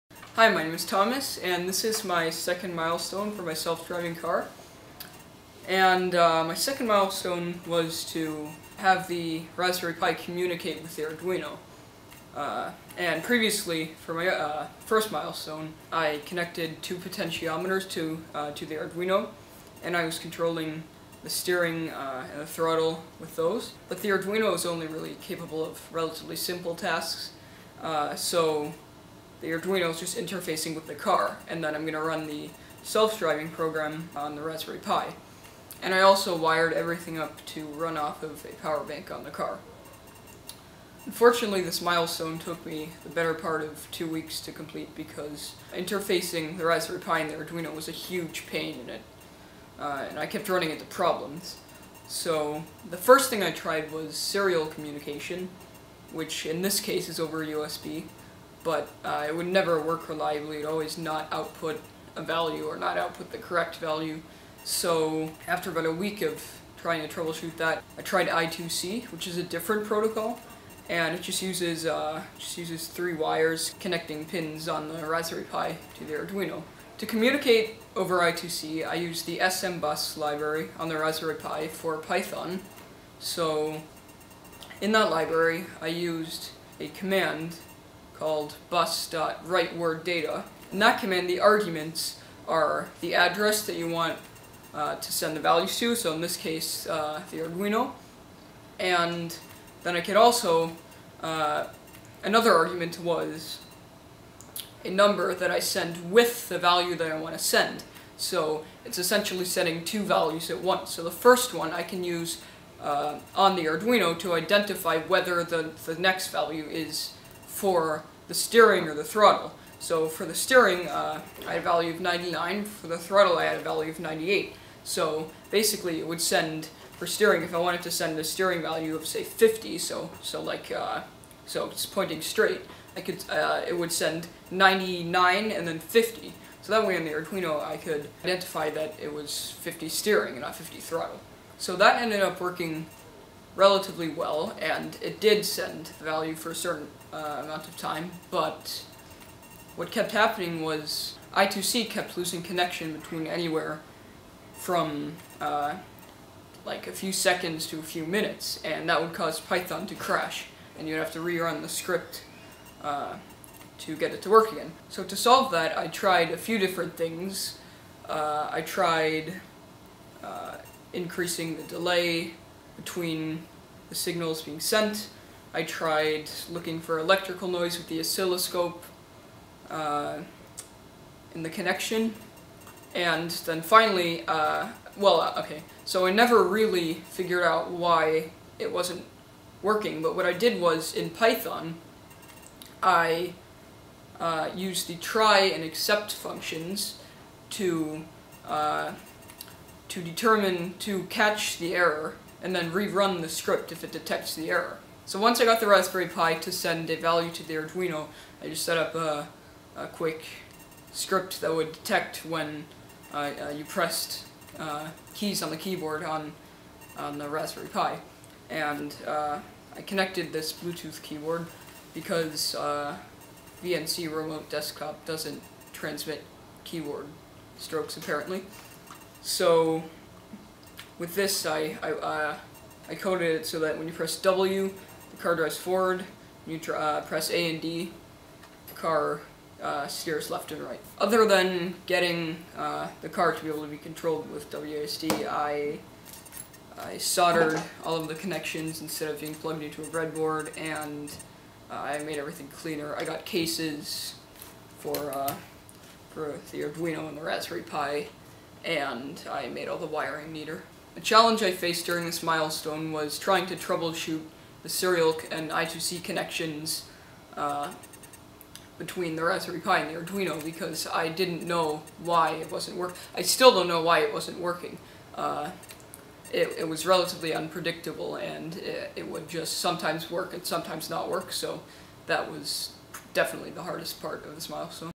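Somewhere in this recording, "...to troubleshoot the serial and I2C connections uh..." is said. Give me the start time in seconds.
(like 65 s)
263 s.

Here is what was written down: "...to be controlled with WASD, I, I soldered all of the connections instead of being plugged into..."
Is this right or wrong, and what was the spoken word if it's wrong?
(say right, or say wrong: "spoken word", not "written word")
right.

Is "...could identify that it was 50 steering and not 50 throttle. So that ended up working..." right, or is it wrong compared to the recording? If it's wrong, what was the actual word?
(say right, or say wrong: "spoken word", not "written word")
right.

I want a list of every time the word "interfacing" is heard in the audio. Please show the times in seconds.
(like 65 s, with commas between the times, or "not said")
30 s, 45 s.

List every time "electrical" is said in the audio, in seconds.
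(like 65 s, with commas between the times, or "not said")
176 s.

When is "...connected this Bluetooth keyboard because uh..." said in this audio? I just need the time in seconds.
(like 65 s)
219 s.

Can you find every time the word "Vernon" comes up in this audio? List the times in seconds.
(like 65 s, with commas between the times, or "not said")
not said.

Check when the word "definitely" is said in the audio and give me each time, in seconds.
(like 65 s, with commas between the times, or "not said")
283 s.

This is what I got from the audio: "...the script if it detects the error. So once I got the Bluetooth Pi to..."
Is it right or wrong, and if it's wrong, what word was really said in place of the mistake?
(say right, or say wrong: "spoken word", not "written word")
wrong: "Raspberry", not "Bluetooth".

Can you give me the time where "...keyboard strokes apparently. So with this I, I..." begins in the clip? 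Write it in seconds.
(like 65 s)
226 s.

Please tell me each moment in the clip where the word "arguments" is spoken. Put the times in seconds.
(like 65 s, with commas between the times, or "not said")
91 s, 102 s.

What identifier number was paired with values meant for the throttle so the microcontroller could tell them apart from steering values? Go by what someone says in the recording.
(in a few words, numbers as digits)
98.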